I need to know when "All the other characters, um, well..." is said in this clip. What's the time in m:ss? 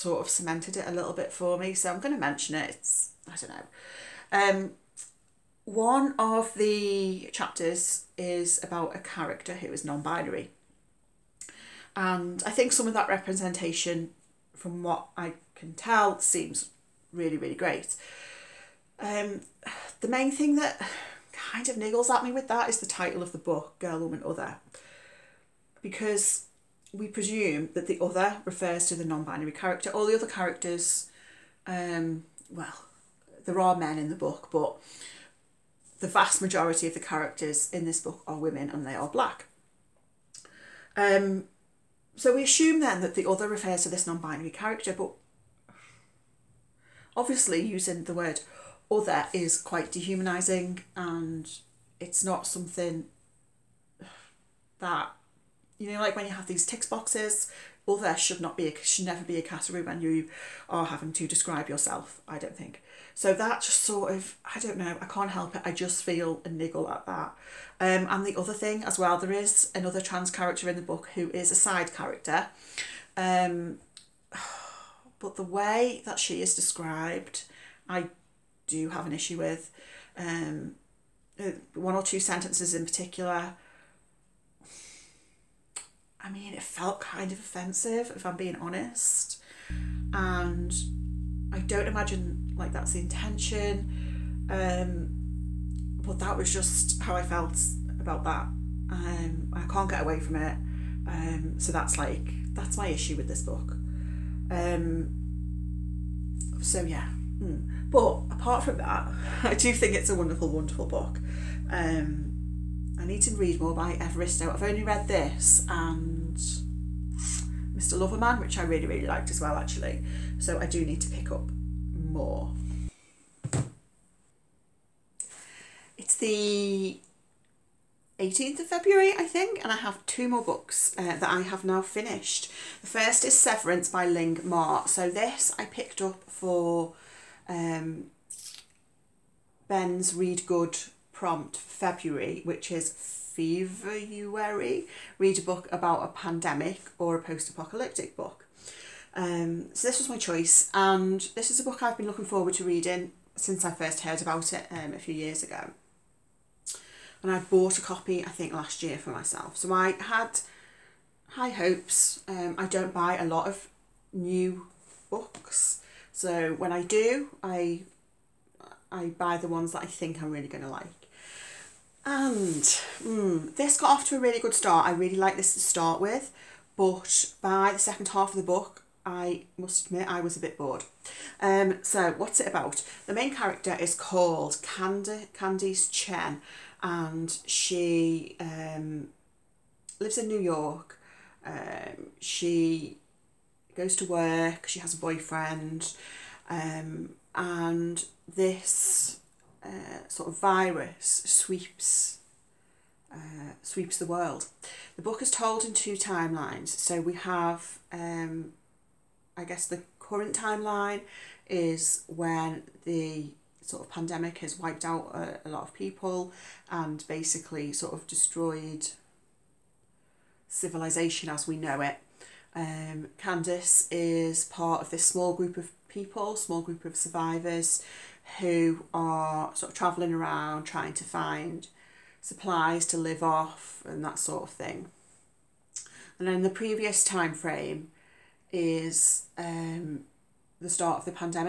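0:29.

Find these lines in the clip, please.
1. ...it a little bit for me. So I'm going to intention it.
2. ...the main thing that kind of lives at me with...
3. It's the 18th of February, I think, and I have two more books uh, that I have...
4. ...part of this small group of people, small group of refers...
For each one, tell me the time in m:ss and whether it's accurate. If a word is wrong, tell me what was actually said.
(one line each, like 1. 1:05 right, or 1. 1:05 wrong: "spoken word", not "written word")
1. 0:00 wrong: "mention", not "intention"
2. 0:19 wrong: "niggles", not "lives"
3. 2:05 right
4. 3:44 wrong: "survivors", not "refers".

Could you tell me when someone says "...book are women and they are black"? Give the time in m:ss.
0:37.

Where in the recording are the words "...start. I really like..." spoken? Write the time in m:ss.
2:54.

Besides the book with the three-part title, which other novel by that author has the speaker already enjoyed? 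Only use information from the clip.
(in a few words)
Mr. Loverman.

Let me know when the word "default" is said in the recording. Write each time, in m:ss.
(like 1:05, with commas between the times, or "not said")
not said.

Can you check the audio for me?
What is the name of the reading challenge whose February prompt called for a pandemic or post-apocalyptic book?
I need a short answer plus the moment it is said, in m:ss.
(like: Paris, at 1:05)
Ben Reads Good, at 2:19.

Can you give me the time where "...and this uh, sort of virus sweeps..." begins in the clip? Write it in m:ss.
3:17.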